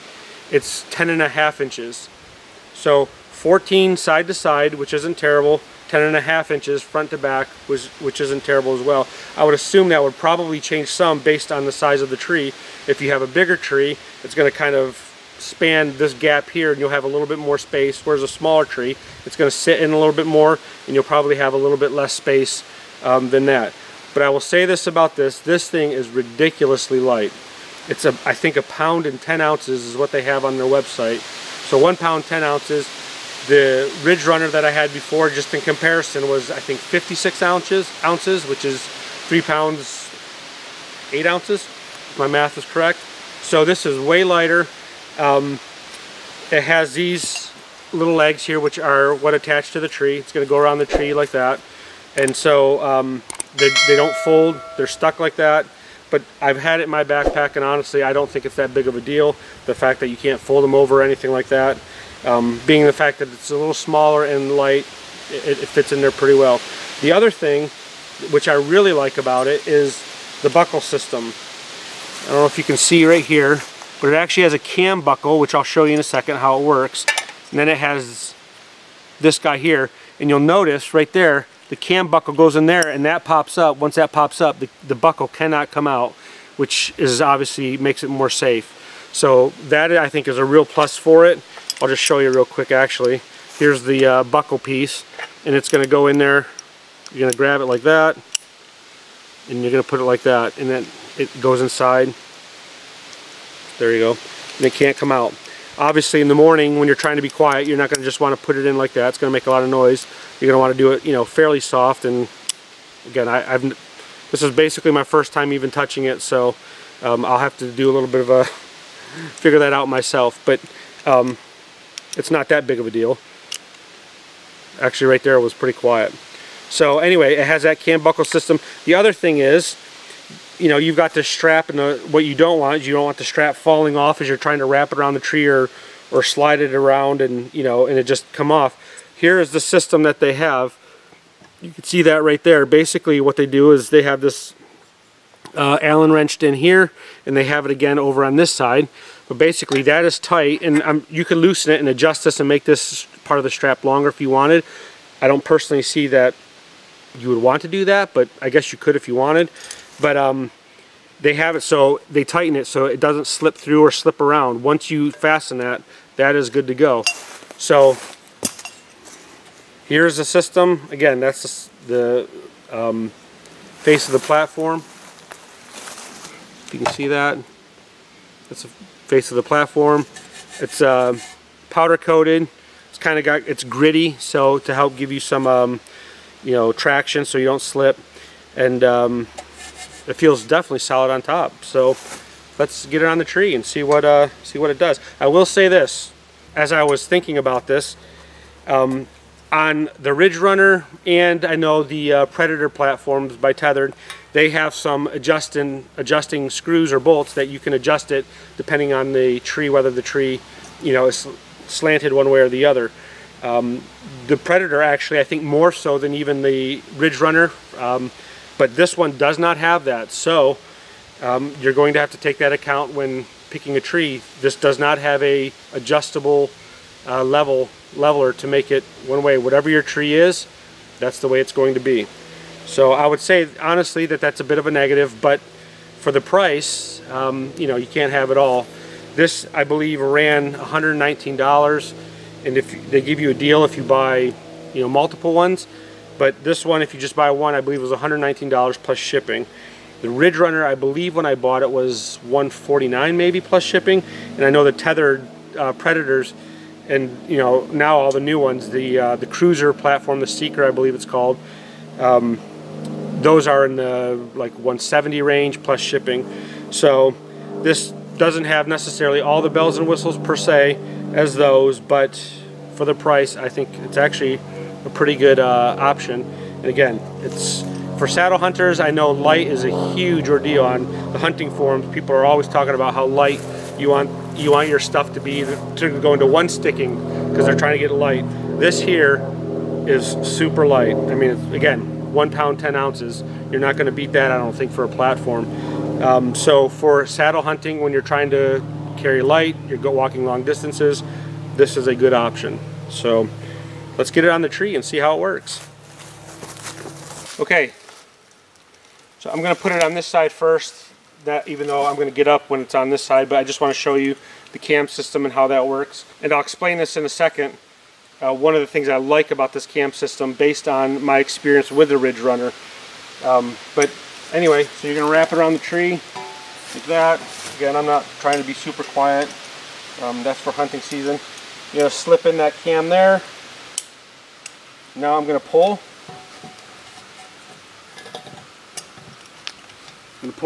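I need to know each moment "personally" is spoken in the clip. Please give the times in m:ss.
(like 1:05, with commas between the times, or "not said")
2:35.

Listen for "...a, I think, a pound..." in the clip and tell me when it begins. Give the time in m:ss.
0:28.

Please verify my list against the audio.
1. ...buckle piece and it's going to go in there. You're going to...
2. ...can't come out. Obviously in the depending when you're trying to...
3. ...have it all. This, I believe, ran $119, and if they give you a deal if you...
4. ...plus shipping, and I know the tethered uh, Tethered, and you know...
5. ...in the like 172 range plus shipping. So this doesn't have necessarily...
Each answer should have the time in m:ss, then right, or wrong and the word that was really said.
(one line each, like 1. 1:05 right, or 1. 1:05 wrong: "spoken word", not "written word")
1. 1:34 right
2. 1:44 wrong: "morning", not "depending"
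3. 3:58 right
4. 4:13 wrong: "Predators", not "Tethered"
5. 4:23 wrong: "170", not "172".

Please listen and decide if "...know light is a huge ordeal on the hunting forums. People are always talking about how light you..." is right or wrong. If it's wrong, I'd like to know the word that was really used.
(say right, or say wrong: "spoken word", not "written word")
right.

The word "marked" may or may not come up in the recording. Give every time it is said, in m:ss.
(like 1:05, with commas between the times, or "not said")
not said.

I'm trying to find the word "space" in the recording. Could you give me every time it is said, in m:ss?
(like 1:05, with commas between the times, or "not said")
0:17, 0:22.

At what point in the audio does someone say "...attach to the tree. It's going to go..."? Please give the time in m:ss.
0:49.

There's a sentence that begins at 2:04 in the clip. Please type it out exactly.
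Actually right there was pretty quiet.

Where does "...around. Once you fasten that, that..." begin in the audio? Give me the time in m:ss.
2:44.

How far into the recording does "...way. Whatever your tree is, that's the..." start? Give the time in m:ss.
3:49.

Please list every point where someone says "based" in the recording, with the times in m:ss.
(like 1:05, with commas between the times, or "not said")
0:11, 5:20.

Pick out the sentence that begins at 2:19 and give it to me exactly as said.
Here is the system that they have.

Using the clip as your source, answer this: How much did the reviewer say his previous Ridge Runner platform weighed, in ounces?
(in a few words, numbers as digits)
56 ounces.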